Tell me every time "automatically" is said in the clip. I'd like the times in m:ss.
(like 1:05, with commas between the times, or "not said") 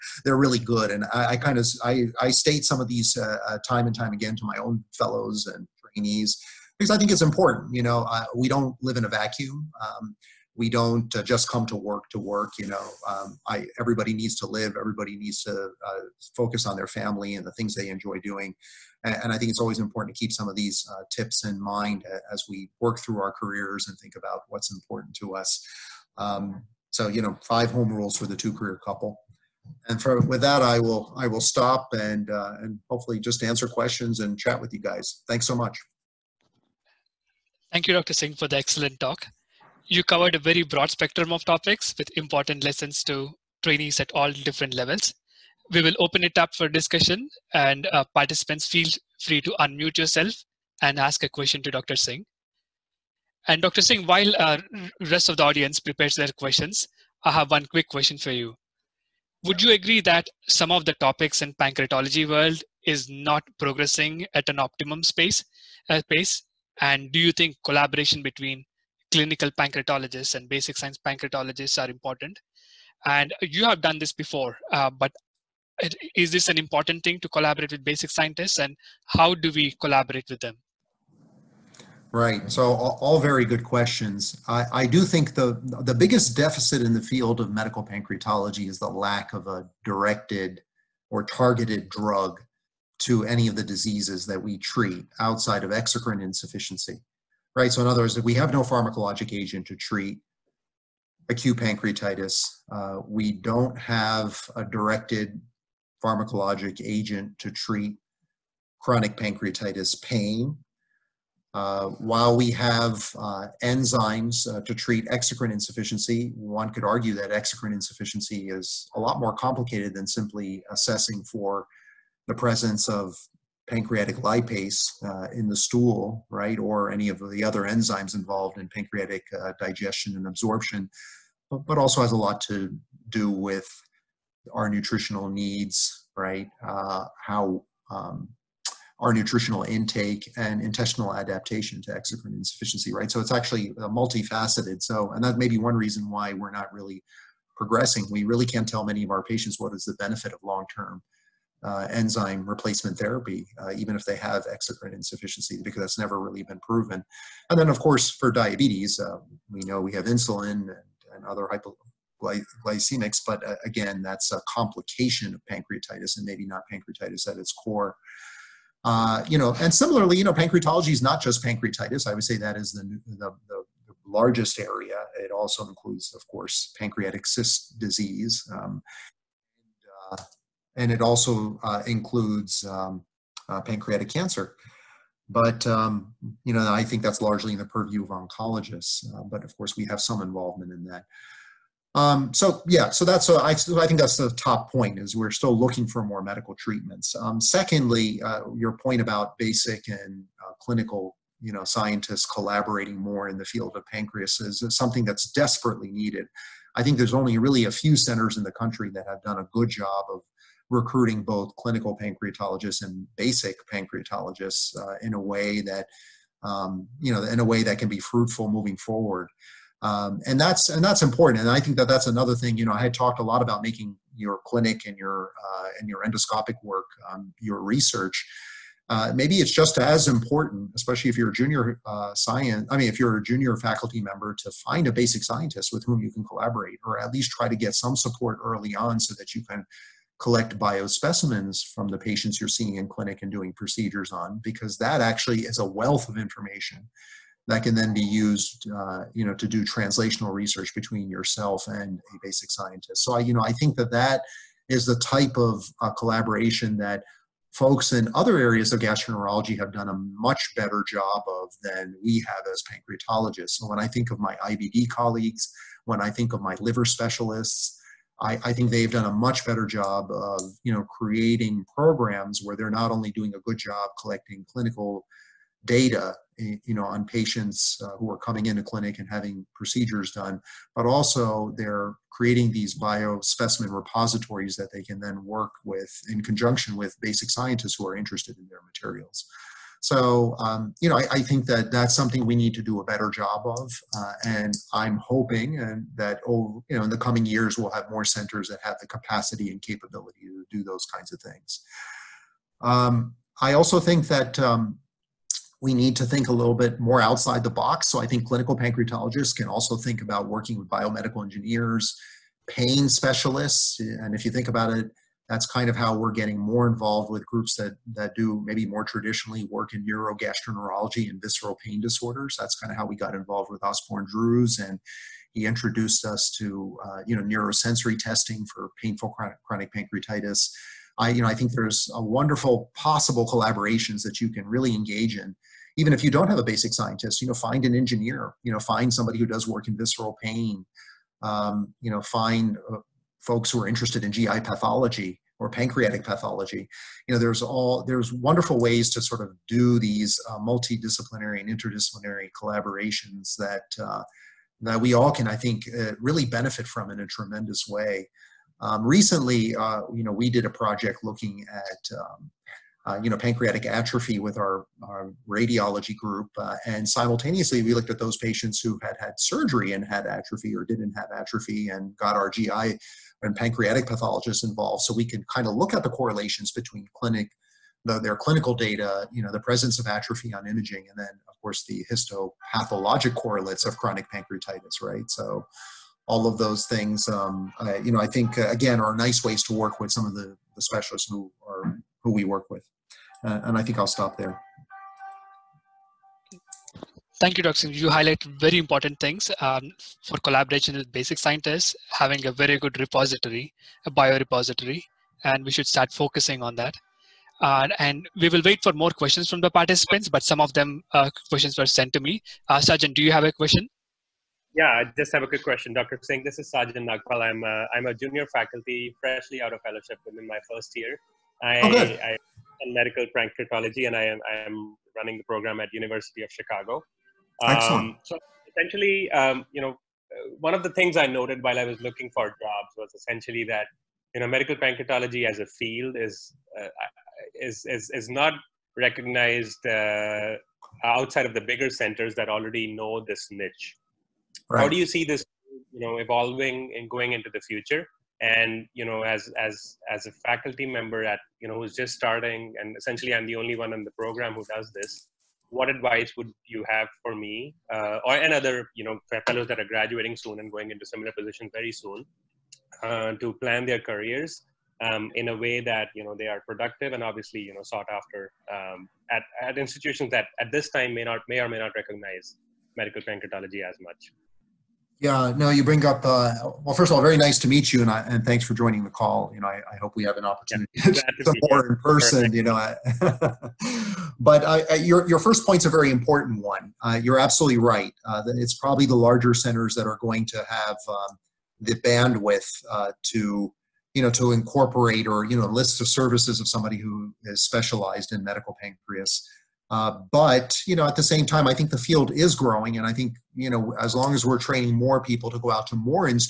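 not said.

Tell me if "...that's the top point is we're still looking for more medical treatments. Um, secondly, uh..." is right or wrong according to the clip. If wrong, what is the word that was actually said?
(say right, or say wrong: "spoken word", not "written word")
right.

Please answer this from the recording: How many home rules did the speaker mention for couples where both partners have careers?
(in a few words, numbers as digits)
5.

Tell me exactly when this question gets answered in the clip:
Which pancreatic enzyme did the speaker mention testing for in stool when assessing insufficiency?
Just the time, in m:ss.
2:03.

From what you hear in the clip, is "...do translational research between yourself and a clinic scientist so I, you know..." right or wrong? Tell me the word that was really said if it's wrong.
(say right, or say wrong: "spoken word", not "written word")
wrong: "basic", not "clinic".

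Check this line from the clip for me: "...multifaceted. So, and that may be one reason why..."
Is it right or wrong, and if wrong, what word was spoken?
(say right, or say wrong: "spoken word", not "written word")
right.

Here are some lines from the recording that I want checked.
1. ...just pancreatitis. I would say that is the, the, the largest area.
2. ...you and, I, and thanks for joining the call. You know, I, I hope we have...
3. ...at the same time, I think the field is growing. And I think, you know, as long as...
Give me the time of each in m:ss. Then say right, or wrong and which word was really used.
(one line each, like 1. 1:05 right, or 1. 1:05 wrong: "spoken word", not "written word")
1. 2:51 right
2. 7:57 right
3. 8:20 right.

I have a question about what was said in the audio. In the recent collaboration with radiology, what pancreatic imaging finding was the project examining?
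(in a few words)
pancreatic atrophy.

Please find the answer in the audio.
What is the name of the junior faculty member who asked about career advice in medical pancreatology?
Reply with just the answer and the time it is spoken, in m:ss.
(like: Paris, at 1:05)
Sajan Nagpal, at 6:56.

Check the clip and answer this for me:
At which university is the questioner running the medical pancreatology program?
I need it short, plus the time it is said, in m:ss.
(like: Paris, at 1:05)
University of Chicago, at 7:05.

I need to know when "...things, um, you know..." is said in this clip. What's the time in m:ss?
6:26.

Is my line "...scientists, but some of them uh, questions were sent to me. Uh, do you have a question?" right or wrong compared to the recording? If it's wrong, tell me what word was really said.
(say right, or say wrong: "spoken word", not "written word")
wrong: "participants", not "scientists".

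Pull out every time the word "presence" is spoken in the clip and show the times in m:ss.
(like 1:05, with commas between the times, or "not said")
2:02, 6:19.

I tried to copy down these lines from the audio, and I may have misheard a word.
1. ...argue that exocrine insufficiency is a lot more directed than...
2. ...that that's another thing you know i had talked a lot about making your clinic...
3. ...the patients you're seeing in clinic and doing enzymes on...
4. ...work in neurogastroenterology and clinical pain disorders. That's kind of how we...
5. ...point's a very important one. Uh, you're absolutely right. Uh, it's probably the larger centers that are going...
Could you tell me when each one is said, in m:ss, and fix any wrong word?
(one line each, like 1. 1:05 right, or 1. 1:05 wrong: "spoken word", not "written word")
1. 1:56 wrong: "complicated", not "directed"
2. 3:41 right
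3. 4:01 wrong: "procedures", not "enzymes"
4. 5:19 wrong: "visceral", not "clinical"
5. 8:05 right.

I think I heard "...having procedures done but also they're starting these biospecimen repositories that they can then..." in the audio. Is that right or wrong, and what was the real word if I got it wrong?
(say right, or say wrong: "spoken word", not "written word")
wrong: "creating", not "starting".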